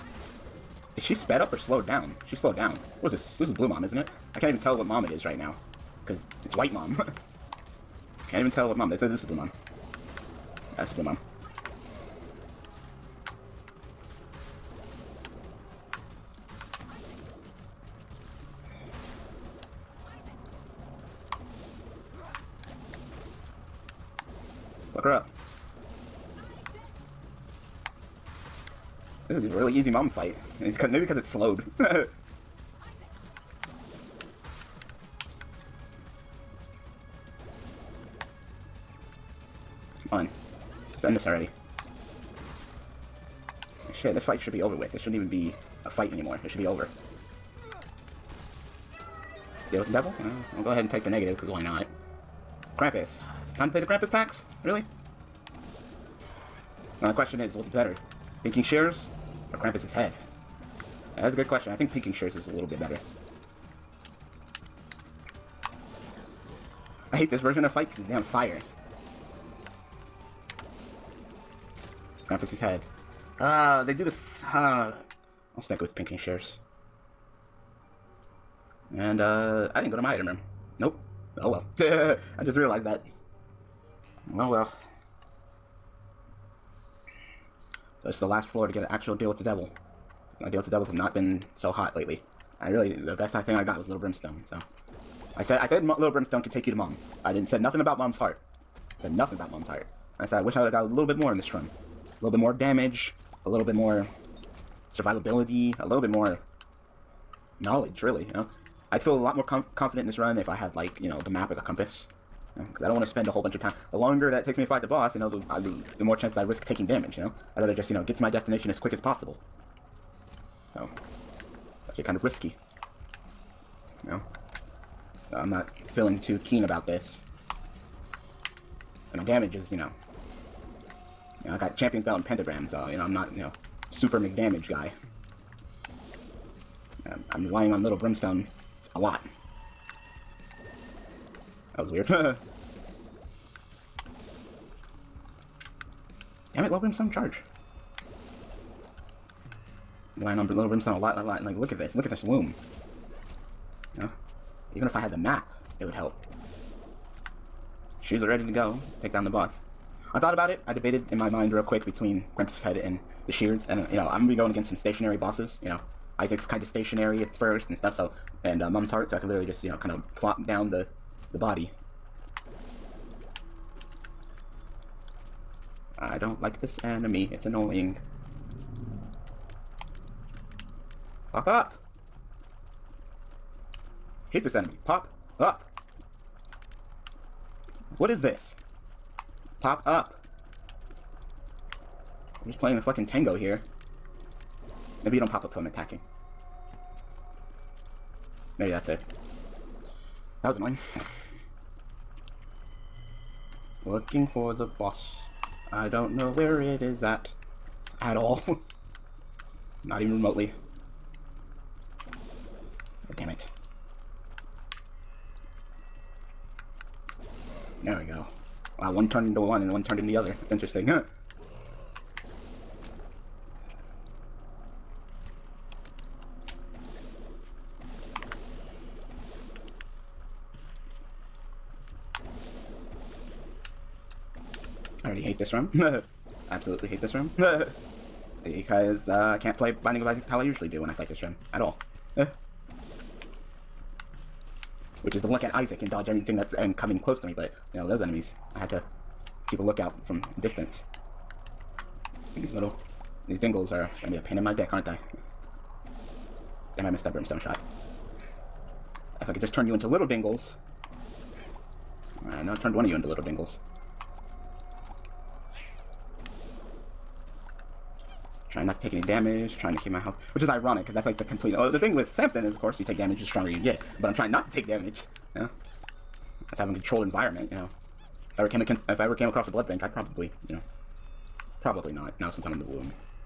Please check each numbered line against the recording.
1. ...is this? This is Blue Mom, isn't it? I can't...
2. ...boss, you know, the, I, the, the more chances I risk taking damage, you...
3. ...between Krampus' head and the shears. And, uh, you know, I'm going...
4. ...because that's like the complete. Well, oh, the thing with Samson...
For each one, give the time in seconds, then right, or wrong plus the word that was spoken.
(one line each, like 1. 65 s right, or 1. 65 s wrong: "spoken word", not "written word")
1. 3 s right
2. 114 s right
3. 161 s right
4. 270 s right.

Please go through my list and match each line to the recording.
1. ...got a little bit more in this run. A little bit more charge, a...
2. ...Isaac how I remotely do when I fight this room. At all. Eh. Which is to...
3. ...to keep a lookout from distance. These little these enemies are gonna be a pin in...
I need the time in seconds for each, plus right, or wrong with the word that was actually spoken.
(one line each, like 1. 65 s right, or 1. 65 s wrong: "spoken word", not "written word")
1. 100 s wrong: "damage", not "charge"
2. 240 s wrong: "usually", not "remotely"
3. 248 s wrong: "dingles", not "enemies".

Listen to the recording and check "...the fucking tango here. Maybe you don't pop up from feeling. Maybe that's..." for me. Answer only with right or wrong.
wrong.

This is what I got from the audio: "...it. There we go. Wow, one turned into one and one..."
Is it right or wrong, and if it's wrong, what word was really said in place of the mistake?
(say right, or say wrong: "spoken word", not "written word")
right.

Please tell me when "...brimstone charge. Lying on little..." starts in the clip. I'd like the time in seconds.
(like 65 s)
146 s.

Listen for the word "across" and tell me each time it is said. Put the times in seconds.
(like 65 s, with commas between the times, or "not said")
279 s.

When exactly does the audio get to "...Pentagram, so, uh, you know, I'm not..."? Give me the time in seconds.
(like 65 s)
132 s.